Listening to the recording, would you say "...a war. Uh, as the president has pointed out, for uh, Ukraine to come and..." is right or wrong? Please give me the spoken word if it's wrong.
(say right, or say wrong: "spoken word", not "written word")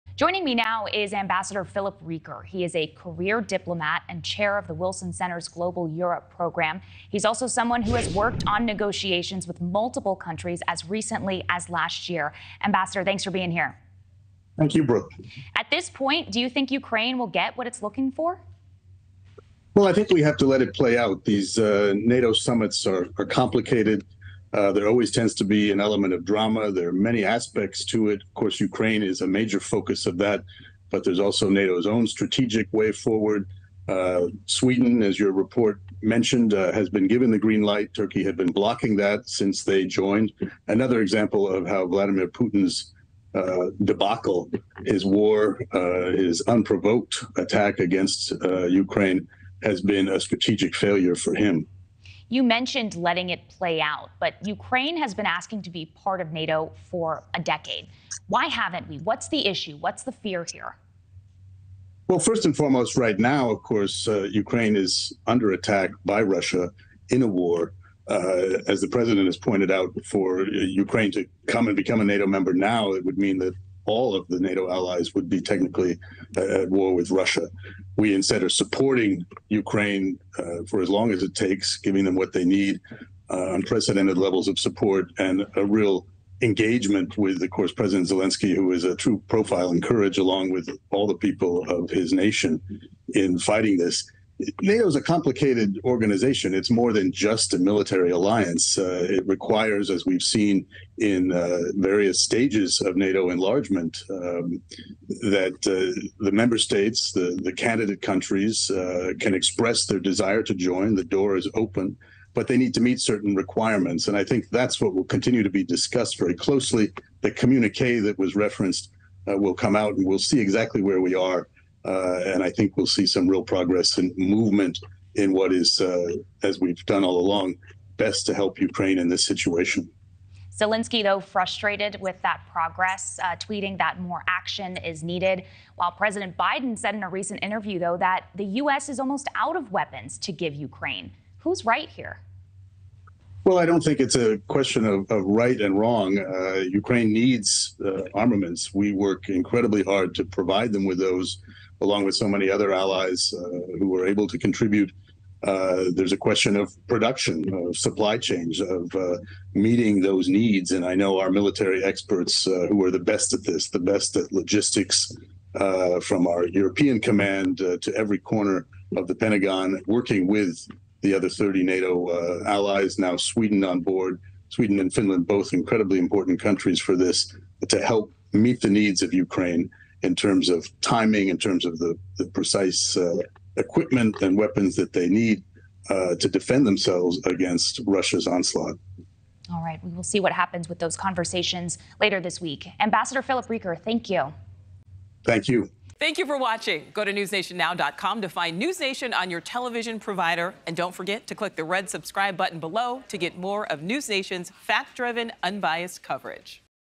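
right.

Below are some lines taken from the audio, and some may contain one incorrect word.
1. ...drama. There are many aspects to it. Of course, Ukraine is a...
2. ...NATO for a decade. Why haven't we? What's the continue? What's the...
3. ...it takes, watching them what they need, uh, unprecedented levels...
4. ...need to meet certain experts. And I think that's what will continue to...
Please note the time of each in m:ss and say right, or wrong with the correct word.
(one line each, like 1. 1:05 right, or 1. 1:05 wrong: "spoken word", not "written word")
1. 0:26 right
2. 0:56 wrong: "issue", not "continue"
3. 1:21 wrong: "giving", not "watching"
4. 1:52 wrong: "requirements", not "experts".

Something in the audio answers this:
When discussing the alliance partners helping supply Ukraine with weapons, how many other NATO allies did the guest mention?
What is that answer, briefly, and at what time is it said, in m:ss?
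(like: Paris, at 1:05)
30, at 2:51.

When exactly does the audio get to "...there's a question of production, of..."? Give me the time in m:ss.
2:35.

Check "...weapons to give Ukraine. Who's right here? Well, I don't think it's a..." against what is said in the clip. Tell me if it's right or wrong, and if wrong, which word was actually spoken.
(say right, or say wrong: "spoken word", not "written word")
right.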